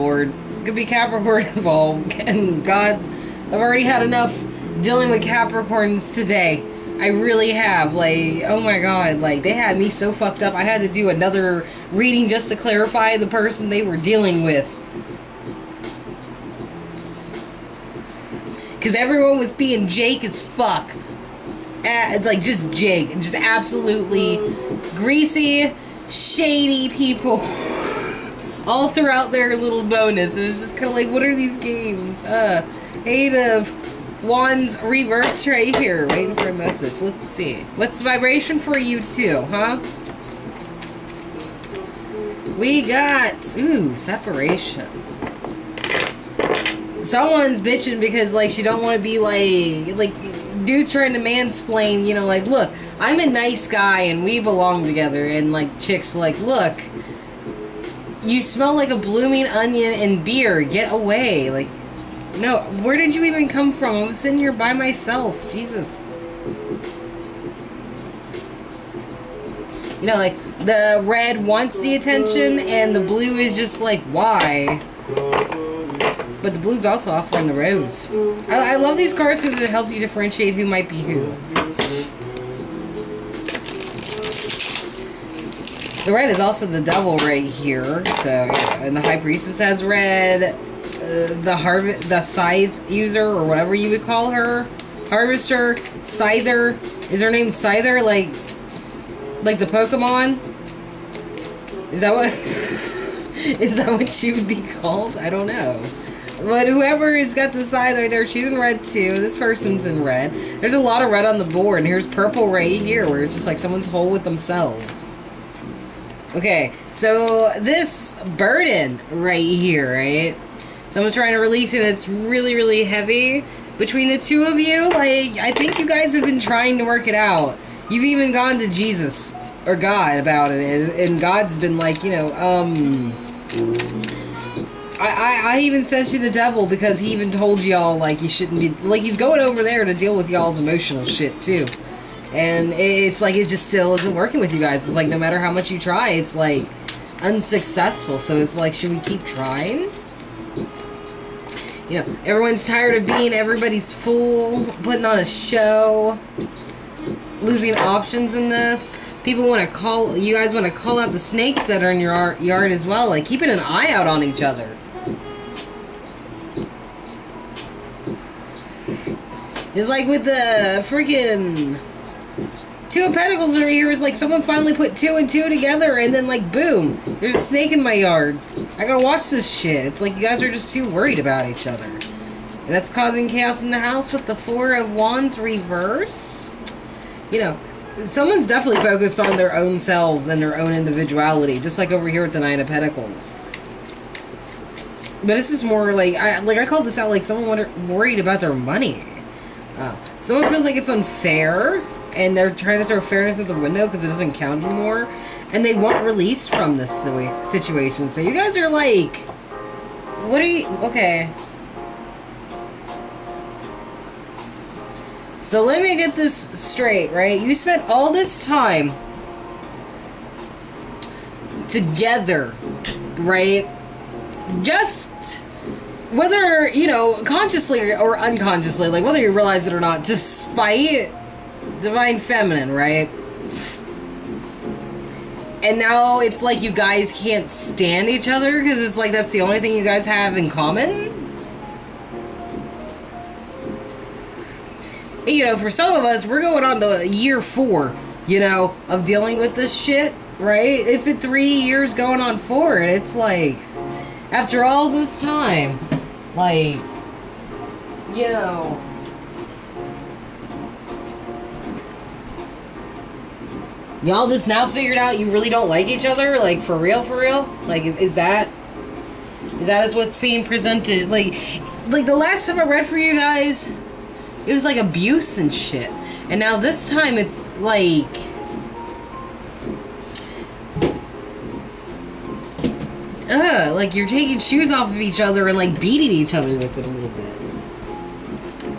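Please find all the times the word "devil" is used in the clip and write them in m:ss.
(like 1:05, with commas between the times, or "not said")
1:26, 2:16.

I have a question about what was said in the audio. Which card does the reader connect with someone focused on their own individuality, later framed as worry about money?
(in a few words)
Nine of Pentacles.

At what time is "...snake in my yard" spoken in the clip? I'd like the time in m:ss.
2:57.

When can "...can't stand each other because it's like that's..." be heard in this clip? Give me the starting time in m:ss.
3:57.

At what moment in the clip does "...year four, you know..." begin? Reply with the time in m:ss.
4:07.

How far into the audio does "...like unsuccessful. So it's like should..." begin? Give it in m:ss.
2:26.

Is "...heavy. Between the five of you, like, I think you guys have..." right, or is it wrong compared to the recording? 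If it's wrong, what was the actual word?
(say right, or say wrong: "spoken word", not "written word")
wrong: "two", not "five".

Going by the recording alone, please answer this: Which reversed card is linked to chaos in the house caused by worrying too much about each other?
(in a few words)
Four of Wands.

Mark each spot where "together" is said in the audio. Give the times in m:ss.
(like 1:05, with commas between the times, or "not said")
0:54, 2:55, 3:41.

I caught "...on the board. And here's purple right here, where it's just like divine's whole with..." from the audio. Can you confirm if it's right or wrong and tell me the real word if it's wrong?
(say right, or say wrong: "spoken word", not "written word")
wrong: "someone", not "divine".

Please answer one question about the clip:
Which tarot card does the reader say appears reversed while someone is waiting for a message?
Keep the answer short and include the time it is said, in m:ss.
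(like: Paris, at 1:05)
Eight of Wands, at 0:33.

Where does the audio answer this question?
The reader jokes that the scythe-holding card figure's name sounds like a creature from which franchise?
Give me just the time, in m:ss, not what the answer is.
1:39.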